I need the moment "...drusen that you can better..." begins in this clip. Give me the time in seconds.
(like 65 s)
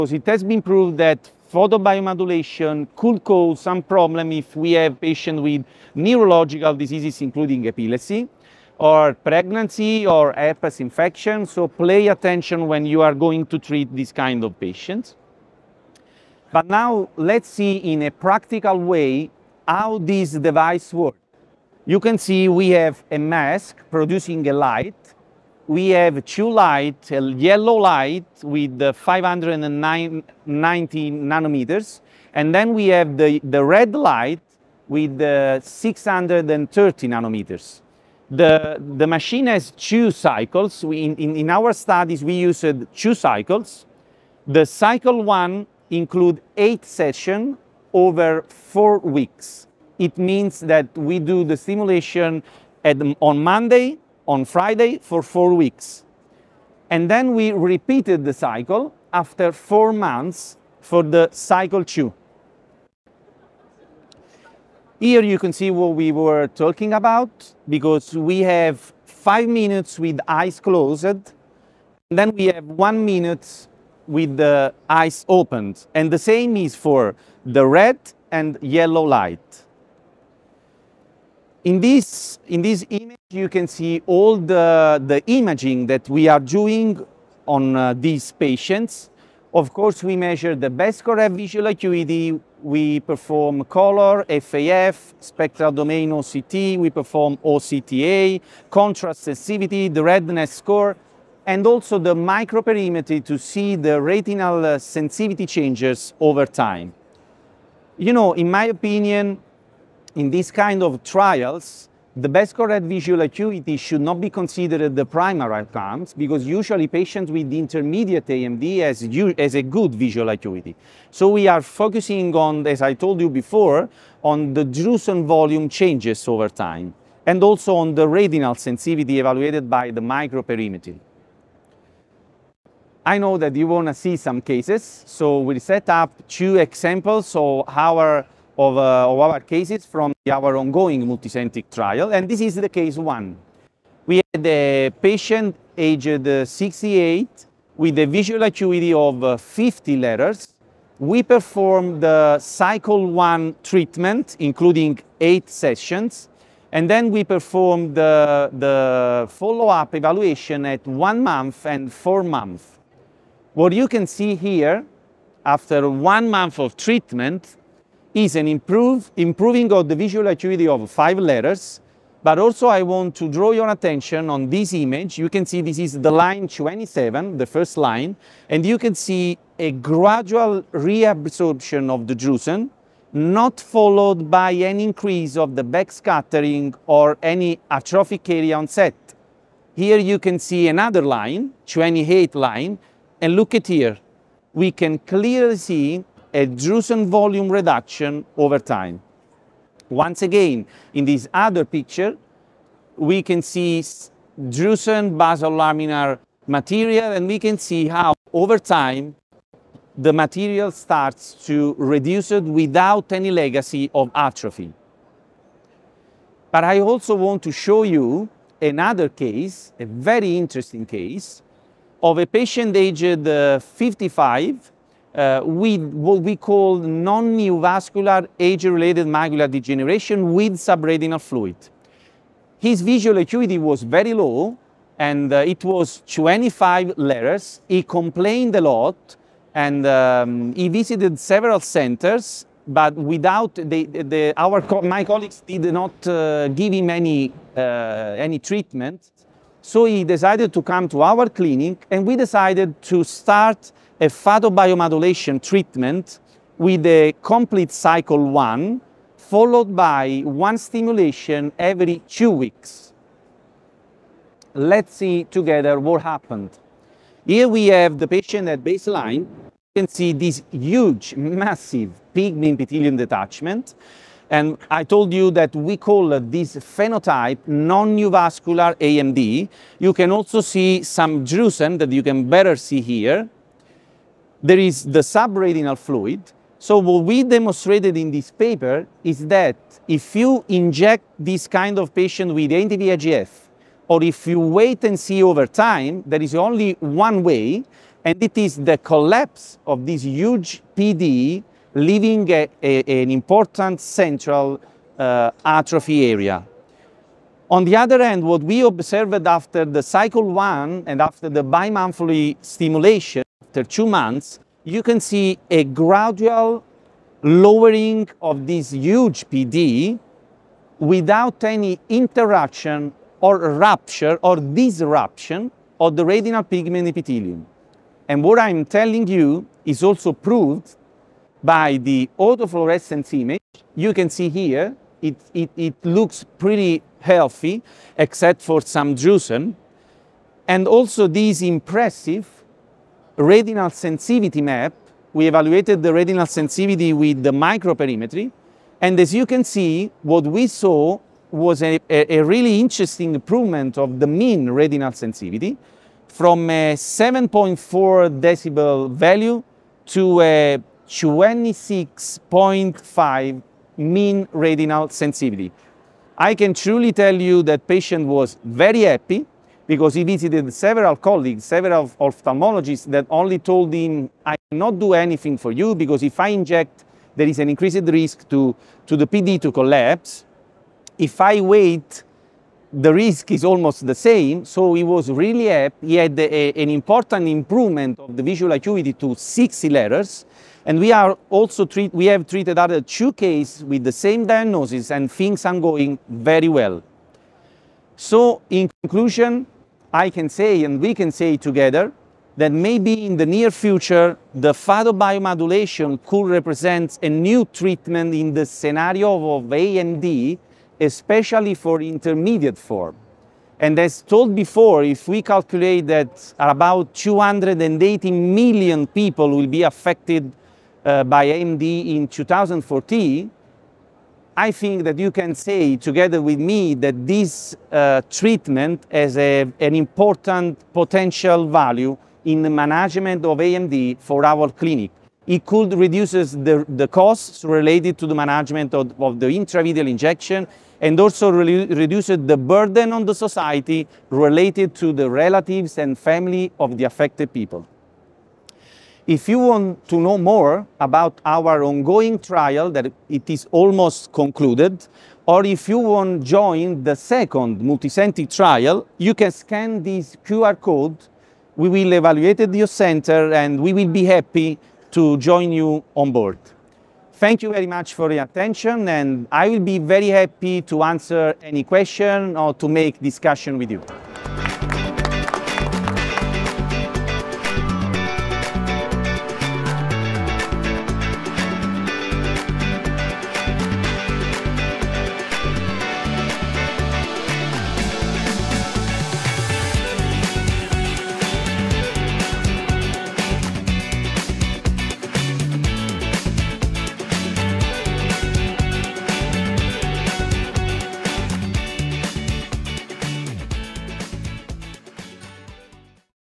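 281 s.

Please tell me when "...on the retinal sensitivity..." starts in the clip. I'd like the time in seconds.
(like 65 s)
127 s.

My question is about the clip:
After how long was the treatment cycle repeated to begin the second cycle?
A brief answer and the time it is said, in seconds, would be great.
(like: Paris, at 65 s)
4 months, at 59 s.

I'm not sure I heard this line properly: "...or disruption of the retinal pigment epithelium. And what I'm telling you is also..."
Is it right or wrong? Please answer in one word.
right.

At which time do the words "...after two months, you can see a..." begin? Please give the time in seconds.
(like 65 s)
313 s.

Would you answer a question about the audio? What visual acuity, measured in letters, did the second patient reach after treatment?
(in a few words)
60 letters.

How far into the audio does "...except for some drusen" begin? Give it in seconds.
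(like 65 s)
337 s.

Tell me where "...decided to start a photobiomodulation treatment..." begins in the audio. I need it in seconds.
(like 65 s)
252 s.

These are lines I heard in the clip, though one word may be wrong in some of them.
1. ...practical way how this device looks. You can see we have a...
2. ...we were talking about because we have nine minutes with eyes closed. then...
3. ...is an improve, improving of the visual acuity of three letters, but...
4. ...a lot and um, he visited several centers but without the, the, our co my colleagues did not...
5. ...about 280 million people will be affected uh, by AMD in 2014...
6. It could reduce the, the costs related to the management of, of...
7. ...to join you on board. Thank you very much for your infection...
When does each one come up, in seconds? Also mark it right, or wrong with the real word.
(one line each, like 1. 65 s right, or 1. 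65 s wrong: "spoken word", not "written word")
1. 18 s wrong: "works", not "looks"
2. 65 s wrong: "five", not "nine"
3. 168 s wrong: "five", not "three"
4. 238 s right
5. 416 s right
6. 435 s right
7. 464 s wrong: "attention", not "infection".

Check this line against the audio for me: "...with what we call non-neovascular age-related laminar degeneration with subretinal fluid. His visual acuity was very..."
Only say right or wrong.
wrong.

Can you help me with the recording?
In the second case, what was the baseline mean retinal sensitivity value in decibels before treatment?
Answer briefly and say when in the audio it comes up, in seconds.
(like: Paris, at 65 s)
7.4 decibels, at 356 s.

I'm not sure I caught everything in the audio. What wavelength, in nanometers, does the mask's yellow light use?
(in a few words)
590 nanometers.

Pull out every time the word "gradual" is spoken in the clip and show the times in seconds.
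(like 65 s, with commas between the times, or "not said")
179 s, 315 s.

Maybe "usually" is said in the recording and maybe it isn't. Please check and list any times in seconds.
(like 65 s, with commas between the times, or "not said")
116 s.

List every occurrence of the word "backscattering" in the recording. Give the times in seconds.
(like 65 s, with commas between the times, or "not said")
185 s.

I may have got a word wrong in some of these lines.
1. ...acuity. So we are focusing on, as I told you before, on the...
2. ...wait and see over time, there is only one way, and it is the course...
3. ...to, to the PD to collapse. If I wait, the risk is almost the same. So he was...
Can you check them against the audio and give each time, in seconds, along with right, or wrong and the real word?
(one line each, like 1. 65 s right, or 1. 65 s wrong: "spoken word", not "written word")
1. 120 s right
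2. 294 s wrong: "collapse", not "course"
3. 378 s right.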